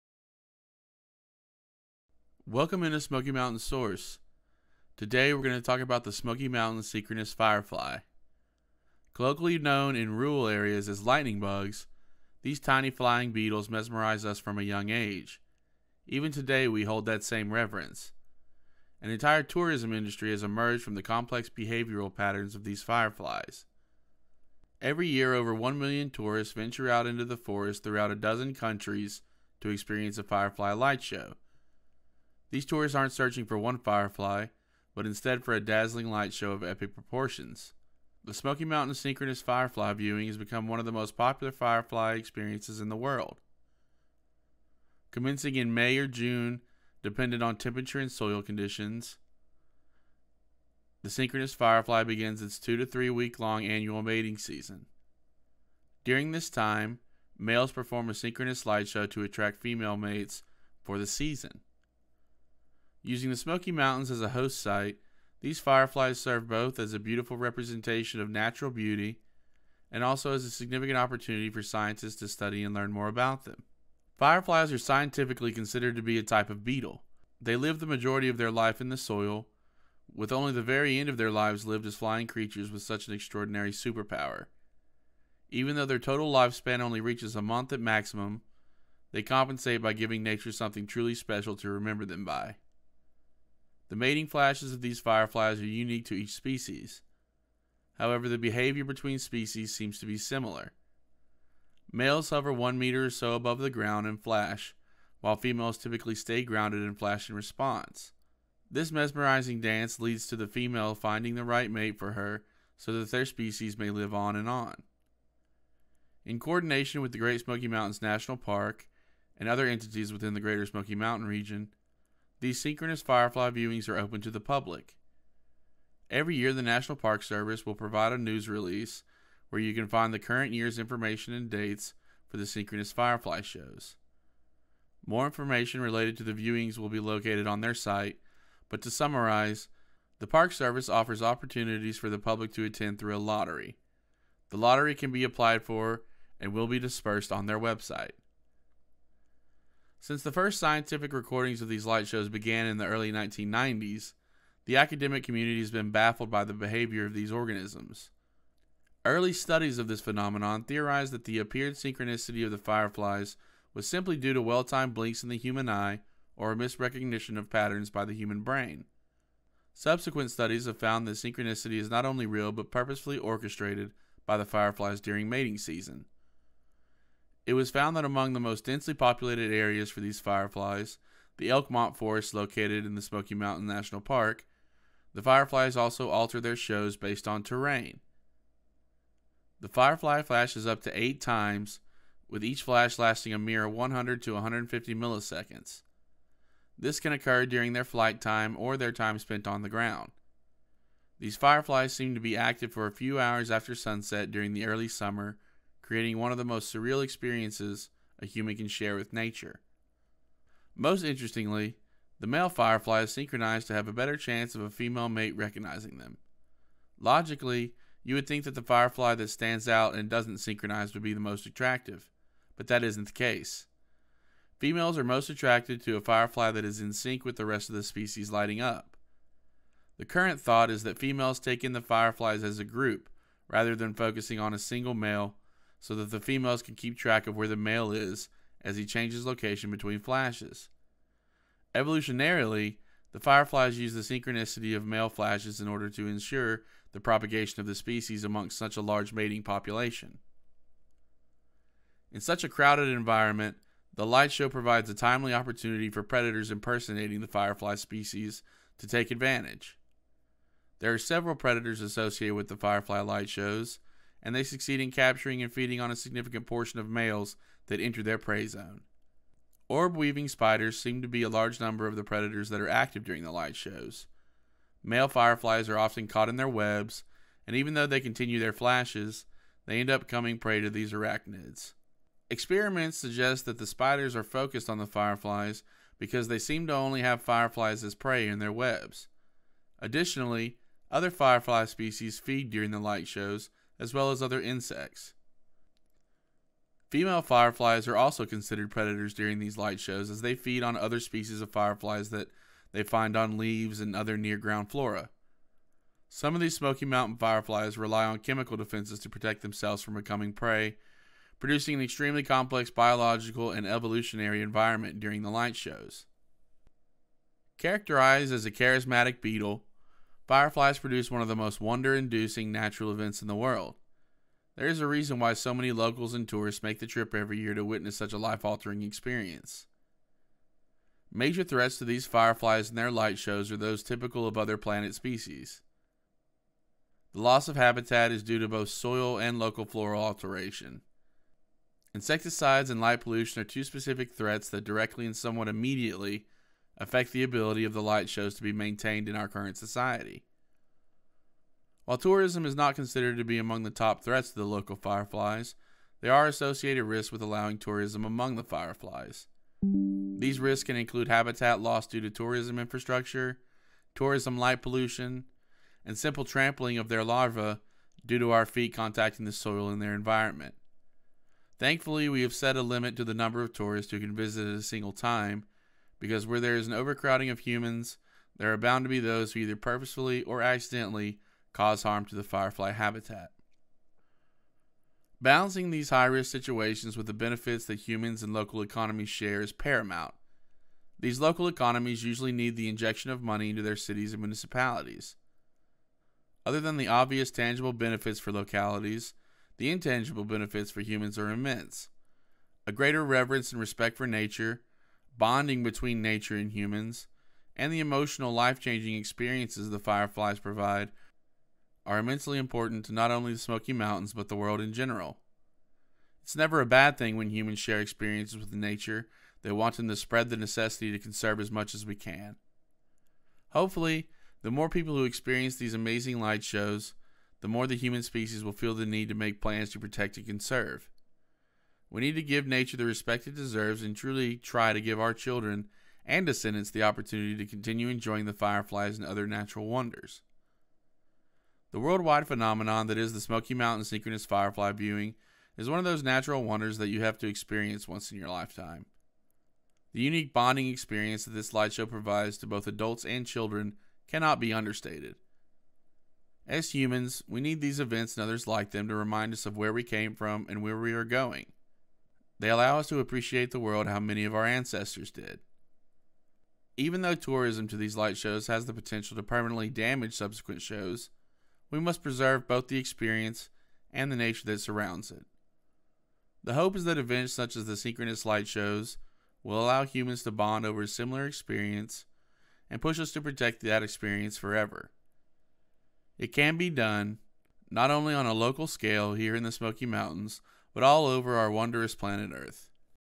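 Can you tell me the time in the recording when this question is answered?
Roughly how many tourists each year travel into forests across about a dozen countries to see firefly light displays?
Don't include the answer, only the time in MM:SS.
00:25.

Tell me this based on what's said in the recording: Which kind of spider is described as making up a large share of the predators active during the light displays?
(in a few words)
Orb weaving spiders.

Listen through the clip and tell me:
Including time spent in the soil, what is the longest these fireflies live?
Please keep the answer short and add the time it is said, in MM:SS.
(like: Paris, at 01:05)
a month, at 01:27.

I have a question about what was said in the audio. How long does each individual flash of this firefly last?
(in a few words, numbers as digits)
100 to 150 milliseconds.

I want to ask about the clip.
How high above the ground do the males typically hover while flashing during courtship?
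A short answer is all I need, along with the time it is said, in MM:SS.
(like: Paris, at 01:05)
1 meter, at 01:42.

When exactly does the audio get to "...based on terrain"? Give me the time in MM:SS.
03:06.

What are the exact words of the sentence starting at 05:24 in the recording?
There is a reason why so many locals and tourists make the trip every year to witness such a life altering experience.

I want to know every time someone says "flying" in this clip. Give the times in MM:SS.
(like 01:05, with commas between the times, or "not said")
00:12, 01:21.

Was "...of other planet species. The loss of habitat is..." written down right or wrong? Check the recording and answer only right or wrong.
right.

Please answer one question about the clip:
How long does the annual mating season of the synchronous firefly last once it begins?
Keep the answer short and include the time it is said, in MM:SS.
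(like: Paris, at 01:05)
2 to 3 weeks, at 00:52.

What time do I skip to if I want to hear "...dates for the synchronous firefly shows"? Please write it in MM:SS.
02:11.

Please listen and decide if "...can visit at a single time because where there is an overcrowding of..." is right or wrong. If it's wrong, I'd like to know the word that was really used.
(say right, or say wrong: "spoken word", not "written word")
right.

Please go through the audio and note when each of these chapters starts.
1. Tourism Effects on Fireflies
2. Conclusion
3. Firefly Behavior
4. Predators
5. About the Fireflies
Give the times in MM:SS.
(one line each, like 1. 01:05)
1. 05:16
2. 07:20
3. 02:30
4. 04:11
5. 01:14.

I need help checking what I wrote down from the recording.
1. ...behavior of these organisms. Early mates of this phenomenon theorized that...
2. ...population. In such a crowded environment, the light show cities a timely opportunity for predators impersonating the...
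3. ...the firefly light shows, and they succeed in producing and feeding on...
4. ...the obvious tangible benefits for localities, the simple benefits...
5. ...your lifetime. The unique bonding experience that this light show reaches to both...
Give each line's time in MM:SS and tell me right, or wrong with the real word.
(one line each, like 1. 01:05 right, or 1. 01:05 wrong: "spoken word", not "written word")
1. 02:36 wrong: "studies", not "mates"
2. 04:09 wrong: "provides", not "cities"
3. 04:22 wrong: "capturing", not "producing"
4. 06:36 wrong: "intangible", not "simple"
5. 07:28 wrong: "provides", not "reaches".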